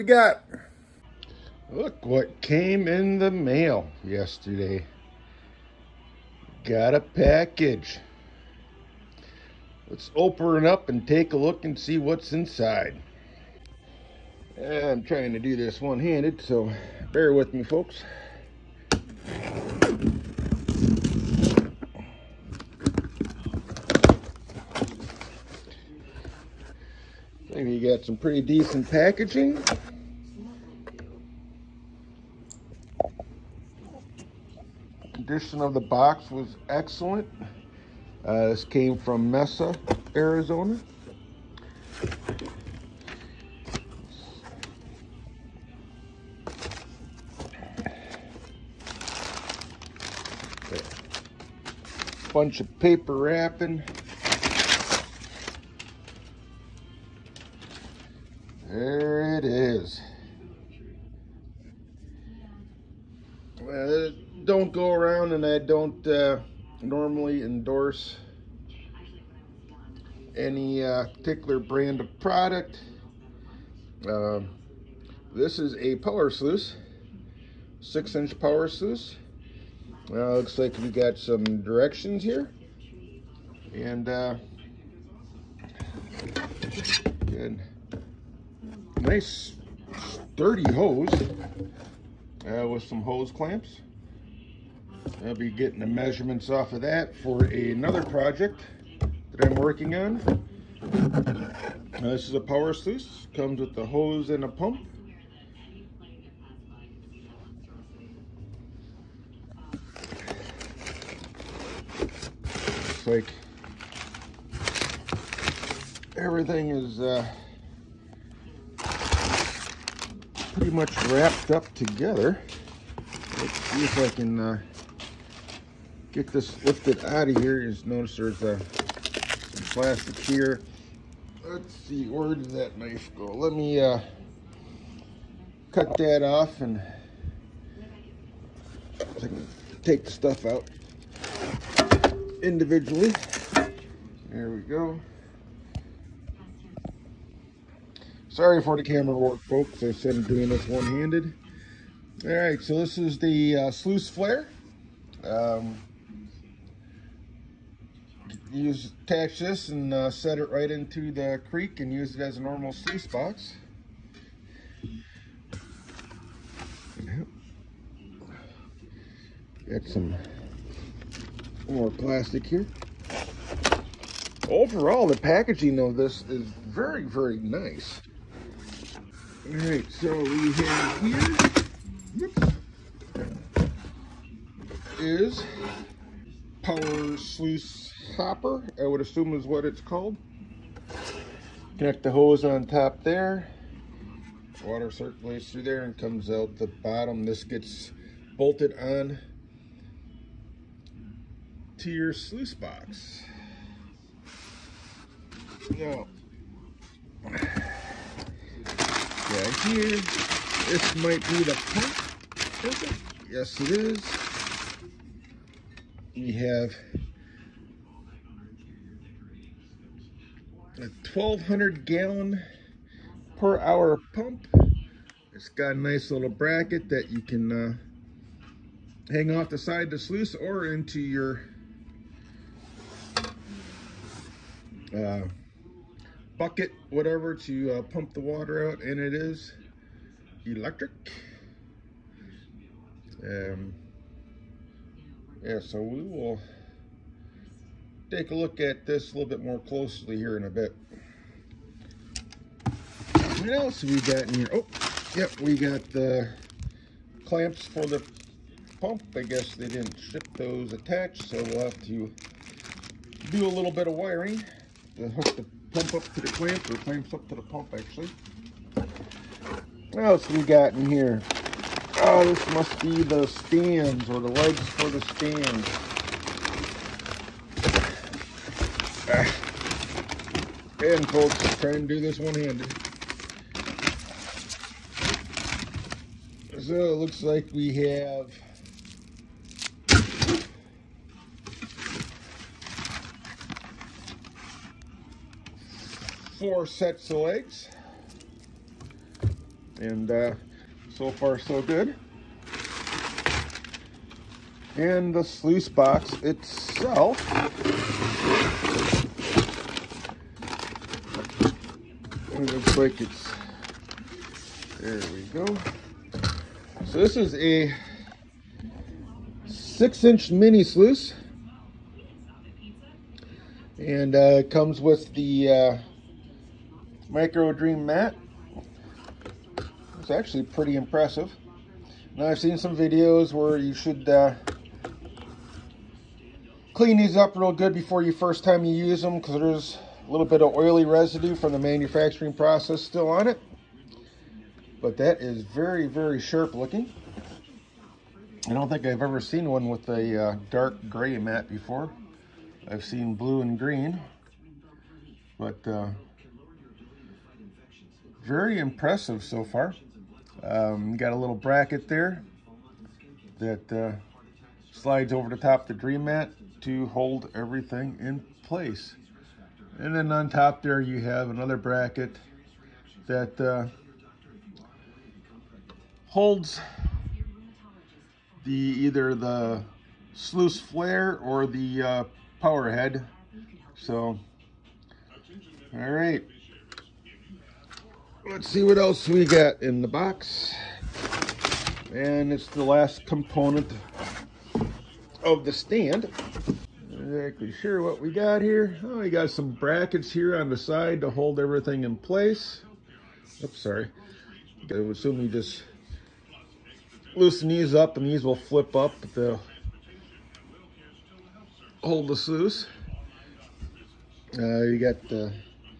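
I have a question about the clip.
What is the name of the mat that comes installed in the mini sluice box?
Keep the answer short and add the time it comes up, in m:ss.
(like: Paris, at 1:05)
Micro Dream mat, at 5:27.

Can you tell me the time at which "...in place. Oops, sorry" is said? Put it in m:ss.
6:41.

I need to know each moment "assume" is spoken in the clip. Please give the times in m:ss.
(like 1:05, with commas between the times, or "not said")
3:08, 6:44.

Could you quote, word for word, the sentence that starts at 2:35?
Um, use attach this and uh, set it right into the creek and use it as a normal sluice box.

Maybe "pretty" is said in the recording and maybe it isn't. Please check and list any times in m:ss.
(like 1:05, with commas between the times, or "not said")
0:28, 2:00, 5:30.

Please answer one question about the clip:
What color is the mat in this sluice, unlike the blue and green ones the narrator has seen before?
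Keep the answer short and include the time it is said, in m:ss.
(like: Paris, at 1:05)
Dark gray, at 5:50.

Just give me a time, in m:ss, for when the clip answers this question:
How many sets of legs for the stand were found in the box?
4:56.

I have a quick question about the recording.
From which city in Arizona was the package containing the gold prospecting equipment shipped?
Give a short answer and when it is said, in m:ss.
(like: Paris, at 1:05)
Mesa, at 0:39.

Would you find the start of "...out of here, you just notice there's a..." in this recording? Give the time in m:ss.
2:07.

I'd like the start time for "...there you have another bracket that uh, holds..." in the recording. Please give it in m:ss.
6:10.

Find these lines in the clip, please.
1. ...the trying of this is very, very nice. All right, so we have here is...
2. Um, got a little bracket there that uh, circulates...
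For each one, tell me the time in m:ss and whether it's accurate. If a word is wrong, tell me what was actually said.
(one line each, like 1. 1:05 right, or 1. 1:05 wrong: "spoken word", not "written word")
1. 2:55 wrong: "packaging", not "trying"
2. 6:00 wrong: "slides", not "circulates".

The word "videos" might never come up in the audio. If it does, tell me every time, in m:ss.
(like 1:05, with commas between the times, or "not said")
5:32.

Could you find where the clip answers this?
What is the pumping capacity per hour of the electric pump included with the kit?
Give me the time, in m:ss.
3:41.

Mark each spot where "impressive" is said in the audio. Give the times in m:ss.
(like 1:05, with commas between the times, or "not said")
5:30, 5:58.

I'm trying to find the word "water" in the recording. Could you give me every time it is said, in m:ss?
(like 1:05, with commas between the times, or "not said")
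3:14, 3:58.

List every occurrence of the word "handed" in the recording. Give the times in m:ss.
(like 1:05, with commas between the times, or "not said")
0:15, 2:30, 4:42.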